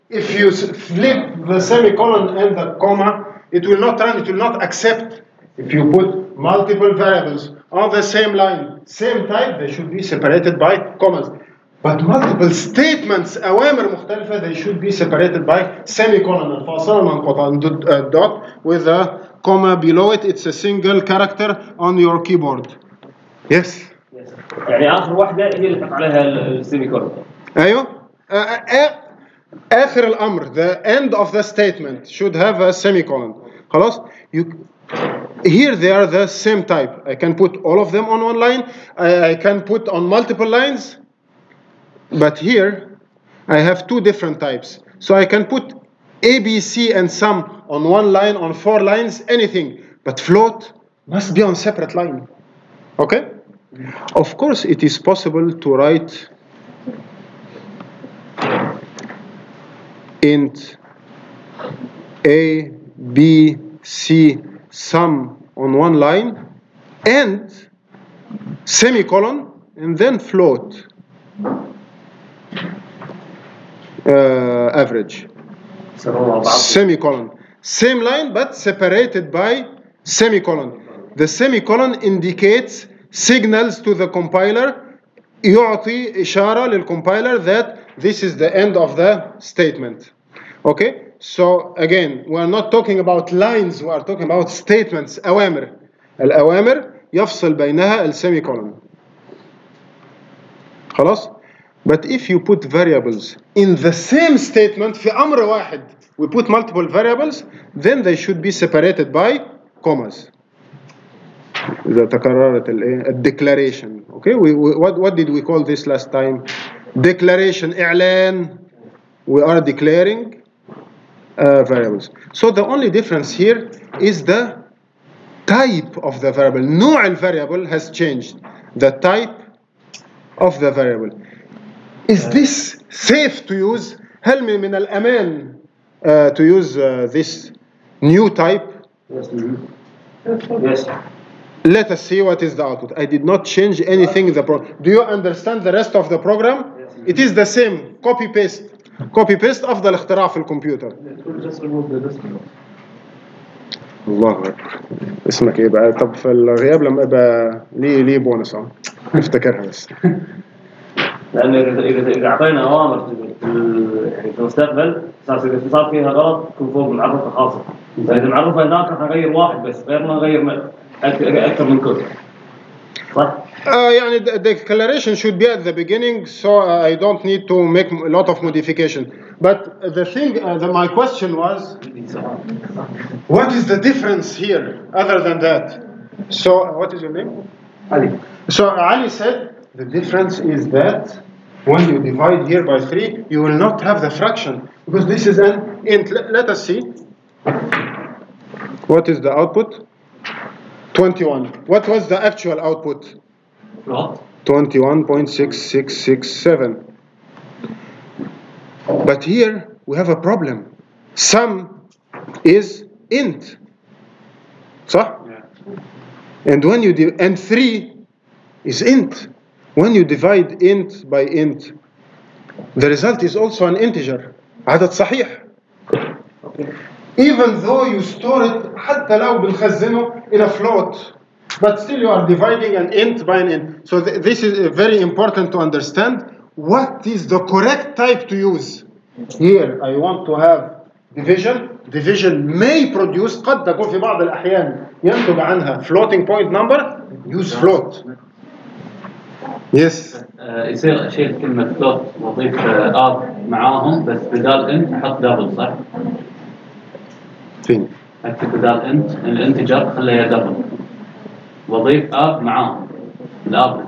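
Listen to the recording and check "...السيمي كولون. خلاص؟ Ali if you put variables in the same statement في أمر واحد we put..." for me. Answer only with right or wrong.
wrong.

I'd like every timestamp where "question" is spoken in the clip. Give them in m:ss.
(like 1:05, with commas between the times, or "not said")
3:00.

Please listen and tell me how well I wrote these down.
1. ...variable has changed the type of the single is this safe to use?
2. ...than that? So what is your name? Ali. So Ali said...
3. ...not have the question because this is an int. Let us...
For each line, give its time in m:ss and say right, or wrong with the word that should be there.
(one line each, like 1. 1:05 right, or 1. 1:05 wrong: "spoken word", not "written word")
1. 2:07 wrong: "variable", not "single"
2. 3:05 right
3. 3:13 wrong: "fraction", not "question".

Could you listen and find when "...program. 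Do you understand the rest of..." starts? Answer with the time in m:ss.
2:24.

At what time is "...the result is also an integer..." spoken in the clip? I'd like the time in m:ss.
3:42.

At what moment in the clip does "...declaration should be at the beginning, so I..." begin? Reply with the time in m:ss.
2:54.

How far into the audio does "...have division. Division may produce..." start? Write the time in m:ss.
4:00.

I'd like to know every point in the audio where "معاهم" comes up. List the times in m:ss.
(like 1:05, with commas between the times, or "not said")
4:13, 4:22.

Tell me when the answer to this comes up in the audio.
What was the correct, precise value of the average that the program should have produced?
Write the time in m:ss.
3:24.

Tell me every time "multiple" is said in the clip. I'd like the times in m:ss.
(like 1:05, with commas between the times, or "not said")
0:06, 0:12, 0:40, 1:46.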